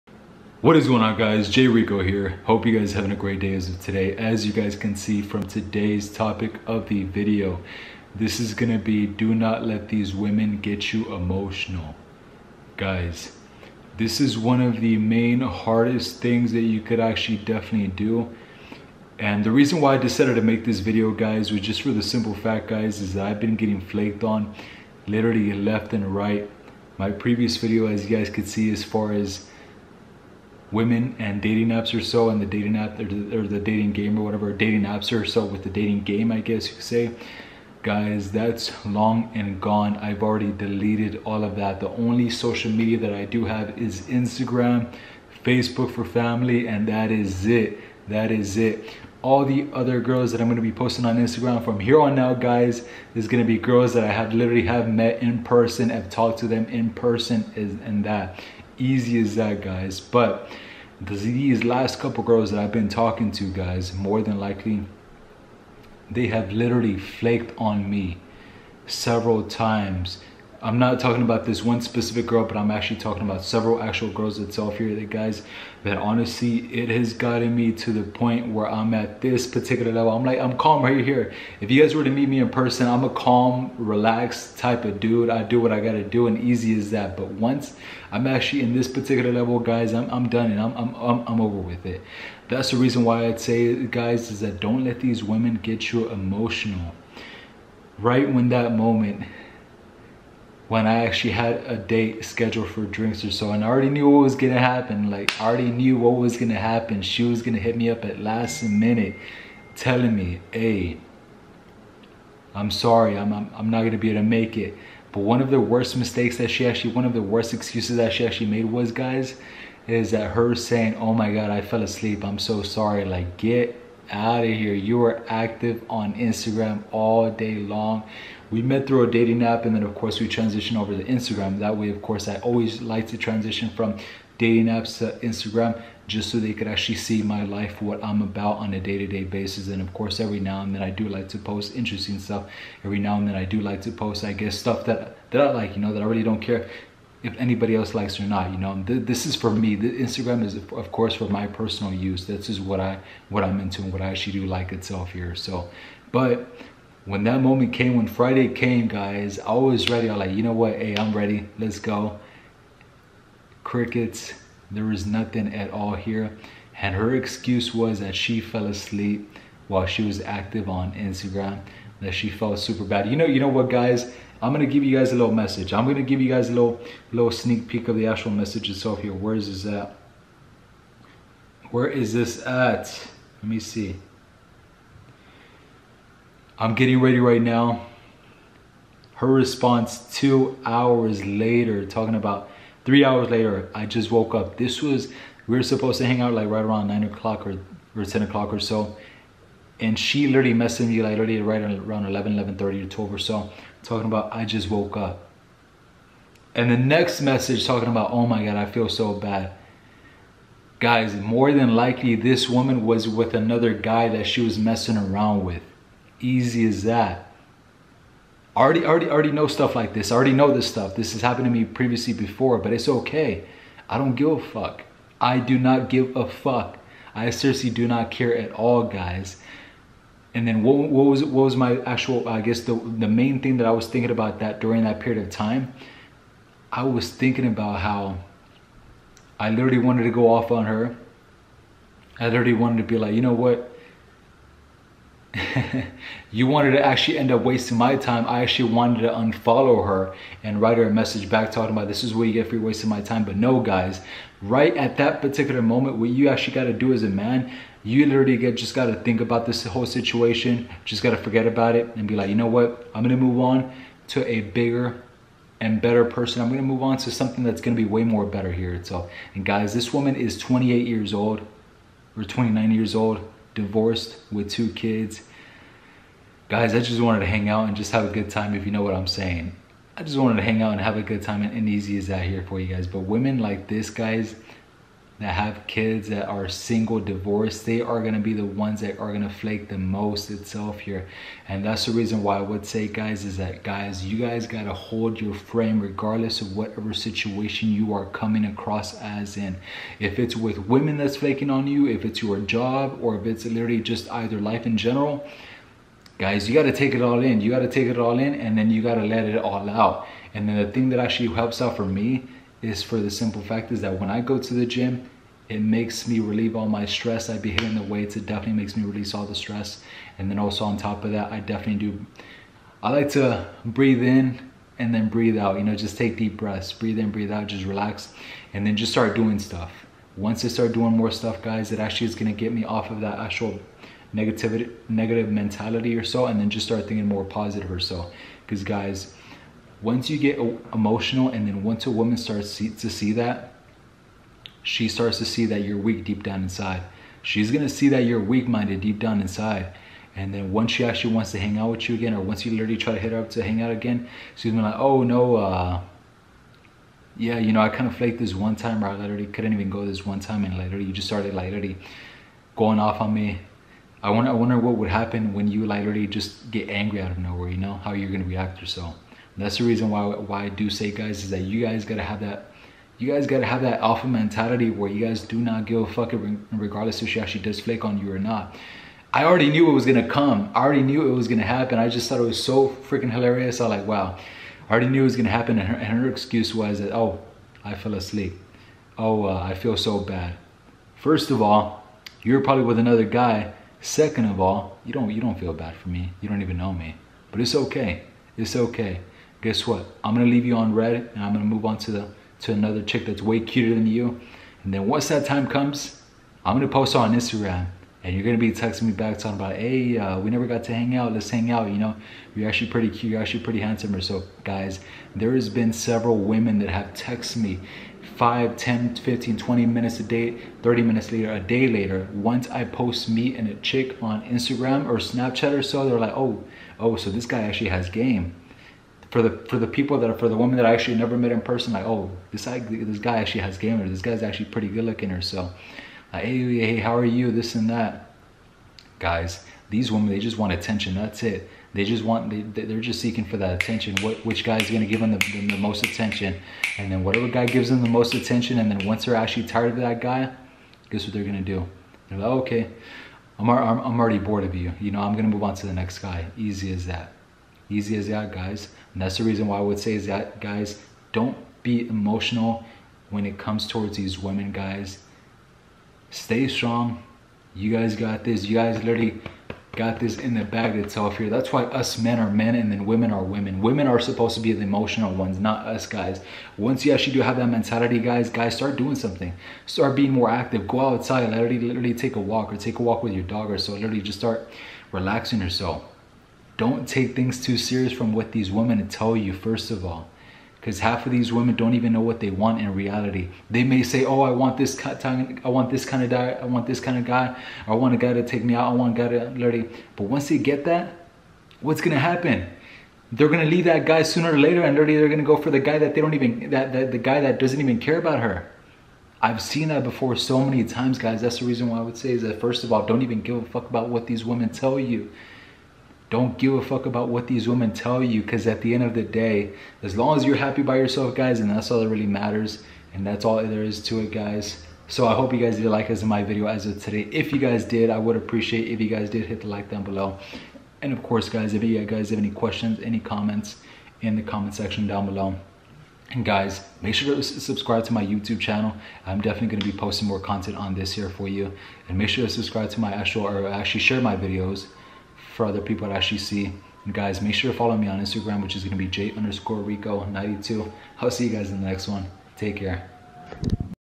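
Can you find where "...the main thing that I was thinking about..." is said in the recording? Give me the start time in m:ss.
3:52.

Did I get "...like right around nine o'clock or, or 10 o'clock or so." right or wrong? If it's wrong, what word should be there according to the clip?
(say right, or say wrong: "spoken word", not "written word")
right.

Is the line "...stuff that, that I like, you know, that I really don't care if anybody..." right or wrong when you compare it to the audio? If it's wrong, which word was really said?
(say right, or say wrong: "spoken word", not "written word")
right.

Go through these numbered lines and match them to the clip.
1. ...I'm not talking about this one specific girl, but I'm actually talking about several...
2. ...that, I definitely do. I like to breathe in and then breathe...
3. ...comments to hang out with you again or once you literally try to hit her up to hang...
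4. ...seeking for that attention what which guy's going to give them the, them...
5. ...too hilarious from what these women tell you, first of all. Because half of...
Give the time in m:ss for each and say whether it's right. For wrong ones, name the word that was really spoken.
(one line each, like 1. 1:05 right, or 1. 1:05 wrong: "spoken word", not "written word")
1. 1:10 right
2. 5:21 right
3. 5:51 wrong: "wants", not "comments"
4. 7:22 right
5. 8:07 wrong: "serious", not "hilarious".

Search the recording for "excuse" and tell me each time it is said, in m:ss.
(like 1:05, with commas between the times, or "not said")
1:57, 2:47, 6:26.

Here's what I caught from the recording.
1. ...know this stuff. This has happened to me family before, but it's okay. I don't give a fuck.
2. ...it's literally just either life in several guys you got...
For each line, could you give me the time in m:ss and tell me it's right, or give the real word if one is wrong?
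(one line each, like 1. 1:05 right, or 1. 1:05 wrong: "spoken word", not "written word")
1. 3:40 wrong: "previously", not "family"
2. 5:03 wrong: "general", not "several".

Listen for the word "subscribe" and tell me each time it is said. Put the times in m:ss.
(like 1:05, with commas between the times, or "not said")
8:57, 9:02.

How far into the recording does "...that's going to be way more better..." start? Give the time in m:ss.
4:27.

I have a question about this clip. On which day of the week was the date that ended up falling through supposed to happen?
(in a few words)
Friday.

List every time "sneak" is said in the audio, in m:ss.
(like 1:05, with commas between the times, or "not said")
2:57.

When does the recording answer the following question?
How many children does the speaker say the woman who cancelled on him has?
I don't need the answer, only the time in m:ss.
4:34.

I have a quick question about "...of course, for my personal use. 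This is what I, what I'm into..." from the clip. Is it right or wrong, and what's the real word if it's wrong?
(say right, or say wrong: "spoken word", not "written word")
right.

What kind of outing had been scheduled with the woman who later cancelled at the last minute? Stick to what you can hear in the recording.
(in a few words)
Drinks.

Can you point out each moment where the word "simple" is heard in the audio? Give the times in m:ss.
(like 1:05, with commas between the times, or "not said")
0:22, 5:13.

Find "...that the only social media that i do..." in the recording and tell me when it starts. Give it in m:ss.
0:41.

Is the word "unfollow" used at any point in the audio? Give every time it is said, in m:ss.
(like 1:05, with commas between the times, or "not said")
4:09.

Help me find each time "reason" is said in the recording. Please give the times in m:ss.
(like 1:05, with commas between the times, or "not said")
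0:19, 1:32, 4:51, 6:09, 7:39, 8:31.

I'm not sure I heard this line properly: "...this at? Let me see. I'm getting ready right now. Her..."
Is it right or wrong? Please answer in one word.
right.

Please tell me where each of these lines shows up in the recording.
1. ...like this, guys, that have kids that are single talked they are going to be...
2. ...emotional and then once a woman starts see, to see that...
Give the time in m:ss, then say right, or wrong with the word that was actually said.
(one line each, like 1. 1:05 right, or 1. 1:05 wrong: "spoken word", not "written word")
1. 4:43 wrong: "divorced", not "talked"
2. 5:40 right.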